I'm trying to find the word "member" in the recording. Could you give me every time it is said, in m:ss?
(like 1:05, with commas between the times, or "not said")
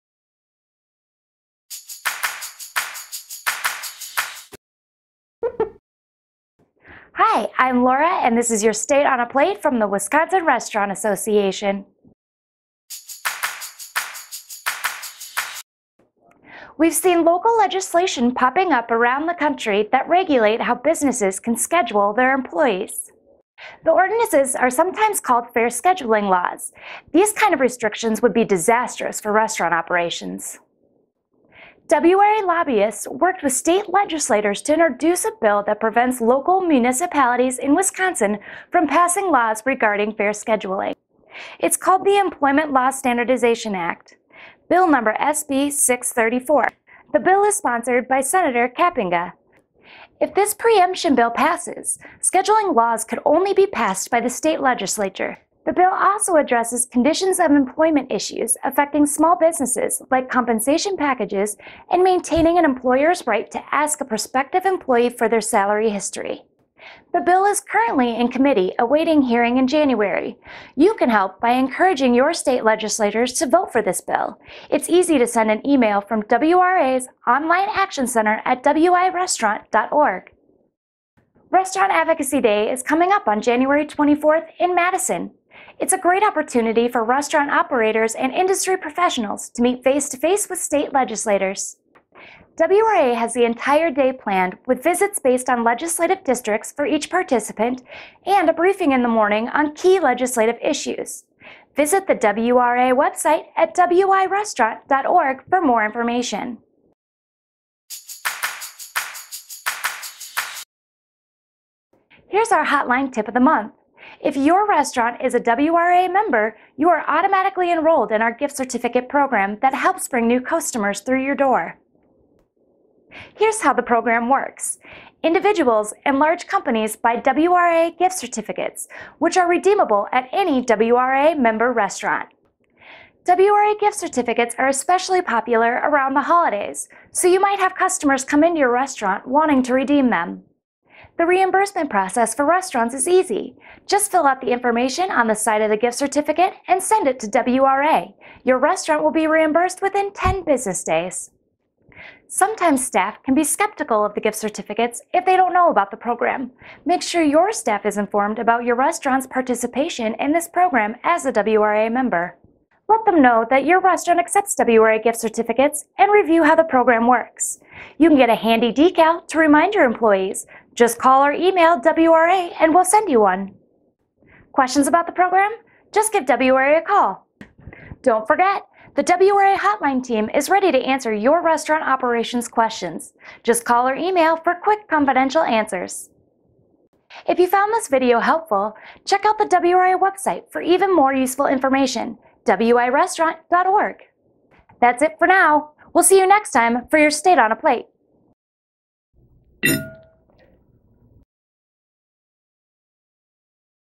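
1:56, 2:11, 2:41.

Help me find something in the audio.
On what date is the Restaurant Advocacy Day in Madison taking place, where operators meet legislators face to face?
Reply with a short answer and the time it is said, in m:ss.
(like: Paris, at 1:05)
January 24, at 1:23.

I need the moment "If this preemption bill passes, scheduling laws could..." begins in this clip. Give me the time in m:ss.
0:50.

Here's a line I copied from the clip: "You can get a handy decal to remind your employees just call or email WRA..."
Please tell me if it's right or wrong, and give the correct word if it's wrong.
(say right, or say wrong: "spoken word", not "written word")
right.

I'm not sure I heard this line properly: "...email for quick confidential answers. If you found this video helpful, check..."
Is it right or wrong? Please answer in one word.
right.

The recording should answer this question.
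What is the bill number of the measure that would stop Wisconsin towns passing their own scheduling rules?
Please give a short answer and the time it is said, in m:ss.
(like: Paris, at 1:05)
SB 634, at 0:45.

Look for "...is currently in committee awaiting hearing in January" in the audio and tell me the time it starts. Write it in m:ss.
1:07.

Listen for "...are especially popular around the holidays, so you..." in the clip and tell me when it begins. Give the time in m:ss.
2:14.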